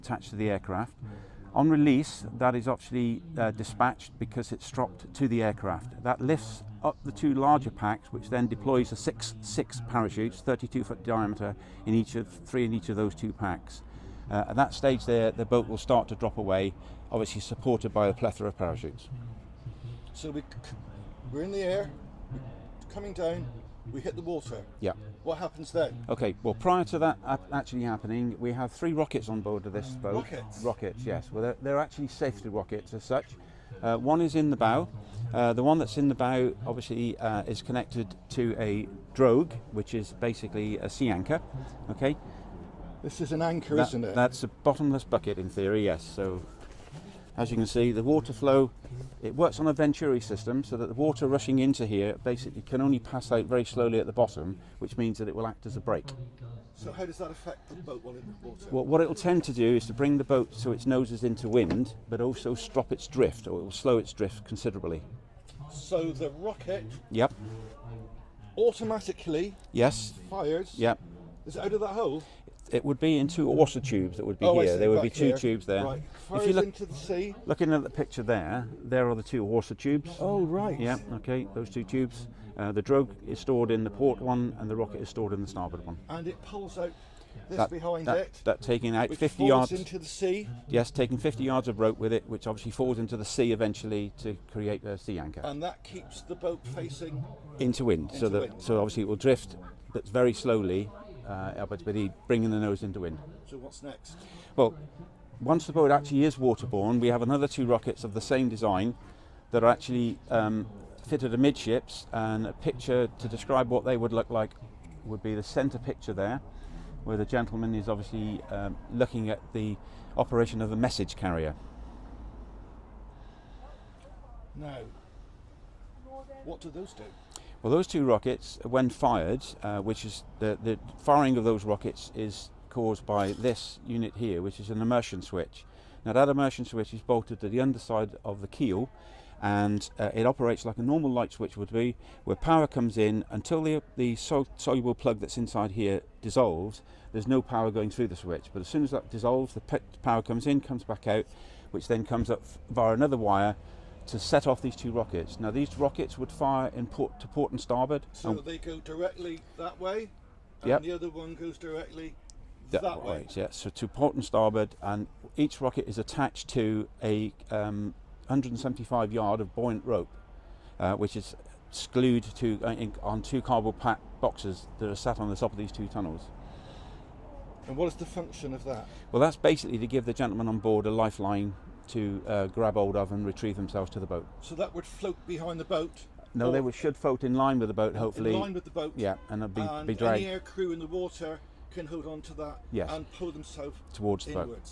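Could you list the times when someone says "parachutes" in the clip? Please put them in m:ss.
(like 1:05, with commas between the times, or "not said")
0:09, 0:18.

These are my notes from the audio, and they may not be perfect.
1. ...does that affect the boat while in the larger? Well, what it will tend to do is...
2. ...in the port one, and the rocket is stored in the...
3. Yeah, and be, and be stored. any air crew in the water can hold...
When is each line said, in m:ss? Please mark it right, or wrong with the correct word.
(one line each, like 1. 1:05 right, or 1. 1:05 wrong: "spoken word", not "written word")
1. 0:57 wrong: "water", not "larger"
2. 1:23 right
3. 3:08 wrong: "dragged", not "stored".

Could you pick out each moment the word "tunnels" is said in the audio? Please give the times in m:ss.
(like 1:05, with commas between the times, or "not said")
2:55.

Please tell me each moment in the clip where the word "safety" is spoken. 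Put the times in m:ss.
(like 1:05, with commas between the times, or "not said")
0:32.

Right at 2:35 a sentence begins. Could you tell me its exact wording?
Now these rockets would fire in port to port and starboard.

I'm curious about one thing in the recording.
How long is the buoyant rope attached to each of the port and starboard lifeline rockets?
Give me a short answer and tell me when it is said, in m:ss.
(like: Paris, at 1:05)
175 yards, at 2:48.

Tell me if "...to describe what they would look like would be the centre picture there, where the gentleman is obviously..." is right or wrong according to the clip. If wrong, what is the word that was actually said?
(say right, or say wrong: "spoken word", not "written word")
right.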